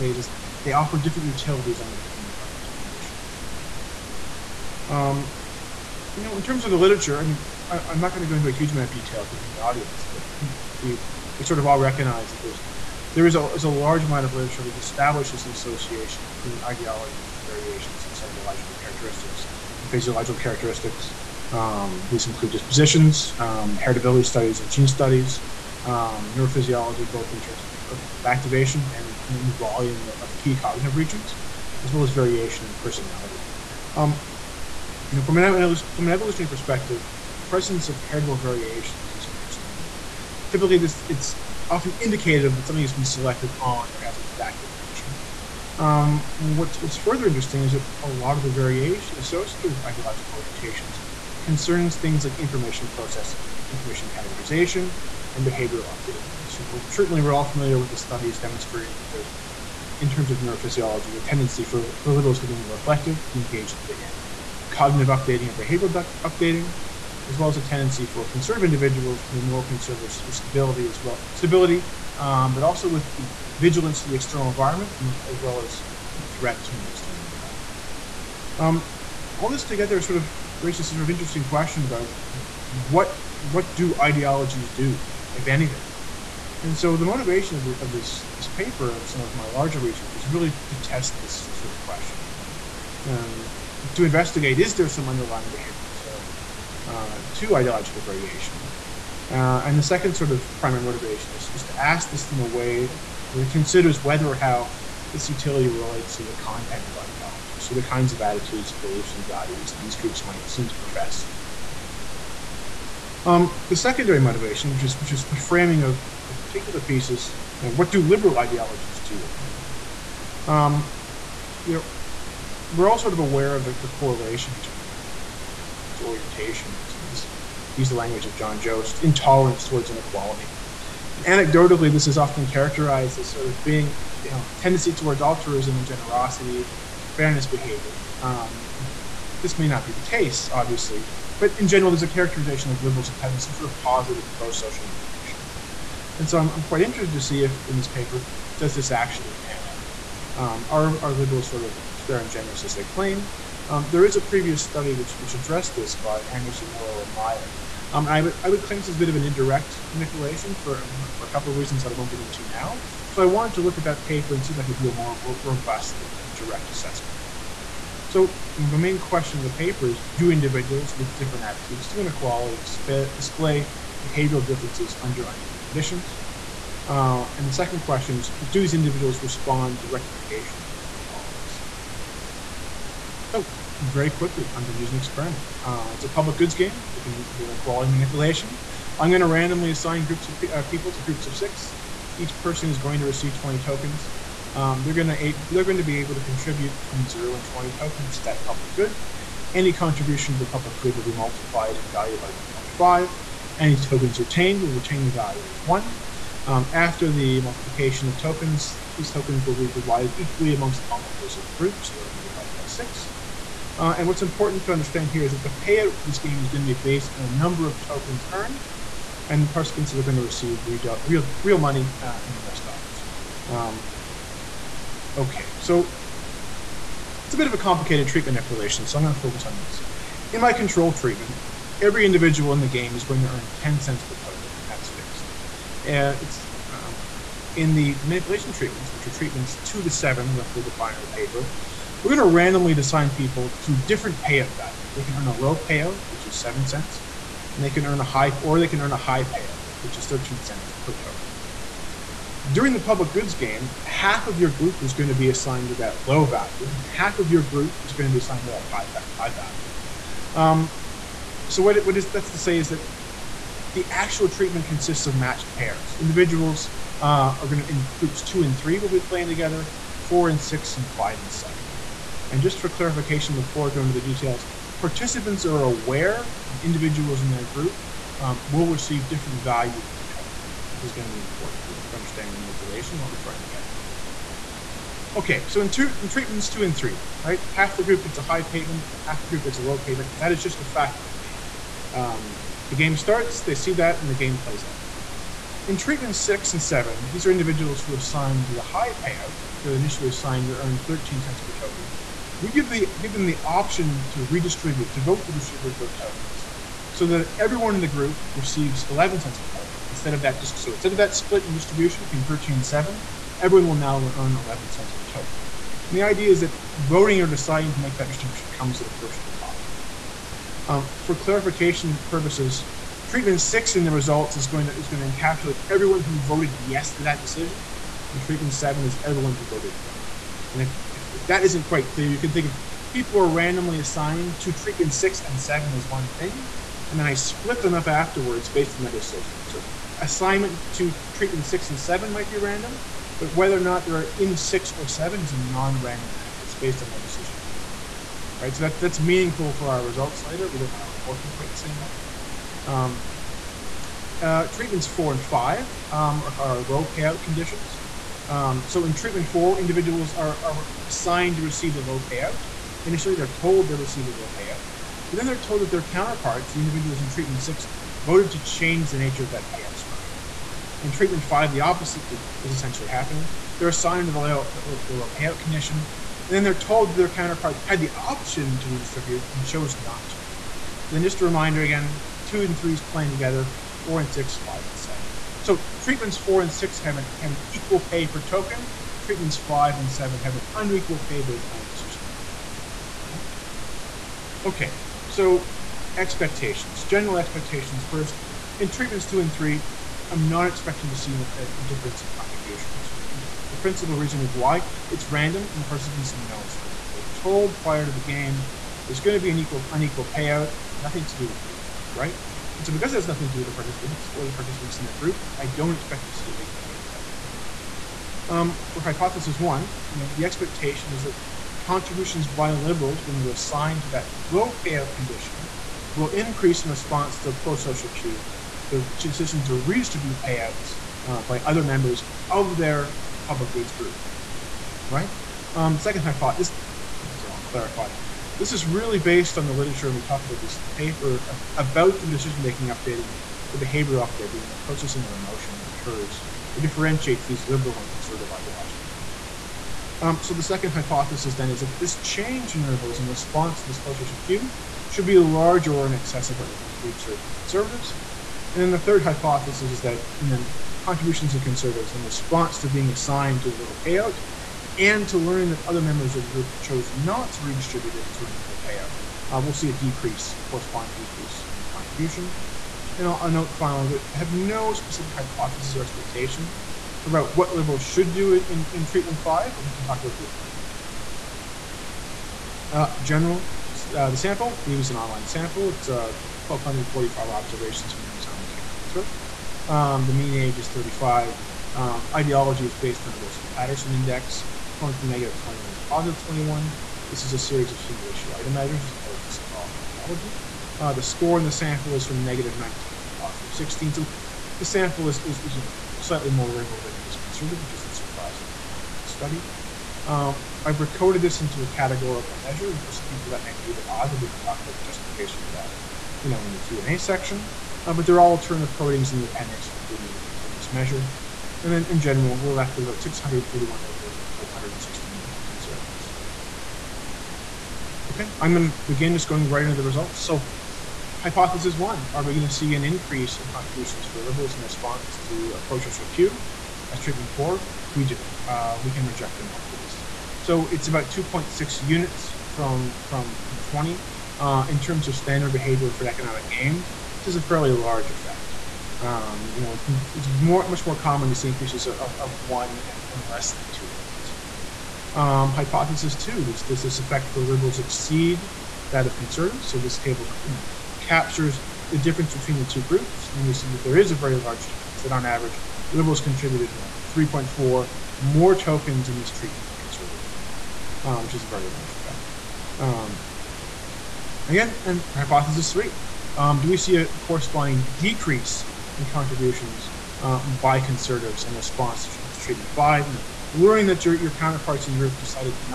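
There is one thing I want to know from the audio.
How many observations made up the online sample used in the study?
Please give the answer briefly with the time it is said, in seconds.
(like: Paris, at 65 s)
1,245, at 485 s.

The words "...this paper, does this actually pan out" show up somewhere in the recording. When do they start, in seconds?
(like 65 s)
147 s.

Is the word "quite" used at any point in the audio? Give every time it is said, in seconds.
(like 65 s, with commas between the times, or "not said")
146 s, 331 s, 351 s.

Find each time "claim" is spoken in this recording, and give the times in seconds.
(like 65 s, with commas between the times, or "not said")
152 s, 158 s.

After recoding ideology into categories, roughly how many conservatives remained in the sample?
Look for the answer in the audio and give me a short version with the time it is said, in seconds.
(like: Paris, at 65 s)
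416, at 524 s.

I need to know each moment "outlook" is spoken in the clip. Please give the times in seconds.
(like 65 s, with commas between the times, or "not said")
not said.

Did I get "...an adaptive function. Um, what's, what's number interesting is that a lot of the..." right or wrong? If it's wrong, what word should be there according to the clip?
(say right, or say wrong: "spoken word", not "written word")
wrong: "further", not "number".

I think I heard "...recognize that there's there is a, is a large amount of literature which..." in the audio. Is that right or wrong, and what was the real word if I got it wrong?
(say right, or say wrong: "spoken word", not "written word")
right.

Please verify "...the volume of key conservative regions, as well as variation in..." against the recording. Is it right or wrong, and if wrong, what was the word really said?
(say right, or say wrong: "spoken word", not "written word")
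wrong: "cognitive", not "conservative".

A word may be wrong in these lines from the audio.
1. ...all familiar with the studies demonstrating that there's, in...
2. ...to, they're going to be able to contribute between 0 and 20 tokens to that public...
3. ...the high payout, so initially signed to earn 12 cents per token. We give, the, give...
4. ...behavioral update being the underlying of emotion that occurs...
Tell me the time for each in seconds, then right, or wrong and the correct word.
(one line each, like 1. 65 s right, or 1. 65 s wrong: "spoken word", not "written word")
1. 57 s right
2. 195 s right
3. 298 s wrong: "13", not "12"
4. 443 s wrong: "processing", not "underlying".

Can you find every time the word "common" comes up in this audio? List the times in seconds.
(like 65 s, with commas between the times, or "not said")
550 s.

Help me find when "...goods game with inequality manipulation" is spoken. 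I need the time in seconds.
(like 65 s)
186 s.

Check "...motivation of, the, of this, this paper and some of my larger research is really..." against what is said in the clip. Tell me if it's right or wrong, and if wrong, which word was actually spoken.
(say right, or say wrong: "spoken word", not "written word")
right.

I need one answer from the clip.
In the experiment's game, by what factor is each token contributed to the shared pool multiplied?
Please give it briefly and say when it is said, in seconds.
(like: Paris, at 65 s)
1.5, at 202 s.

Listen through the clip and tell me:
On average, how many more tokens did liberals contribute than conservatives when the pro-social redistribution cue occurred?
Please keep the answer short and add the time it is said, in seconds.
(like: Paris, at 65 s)
3.4, at 567 s.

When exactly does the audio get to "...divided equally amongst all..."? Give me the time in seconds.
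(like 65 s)
209 s.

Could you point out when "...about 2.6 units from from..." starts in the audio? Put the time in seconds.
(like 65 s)
540 s.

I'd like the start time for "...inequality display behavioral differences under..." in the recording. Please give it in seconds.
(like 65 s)
172 s.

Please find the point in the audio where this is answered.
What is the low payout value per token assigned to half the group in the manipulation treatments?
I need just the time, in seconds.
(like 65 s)
246 s.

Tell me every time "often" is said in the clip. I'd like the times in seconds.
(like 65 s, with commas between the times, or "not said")
41 s, 132 s.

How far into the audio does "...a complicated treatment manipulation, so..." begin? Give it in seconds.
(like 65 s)
227 s.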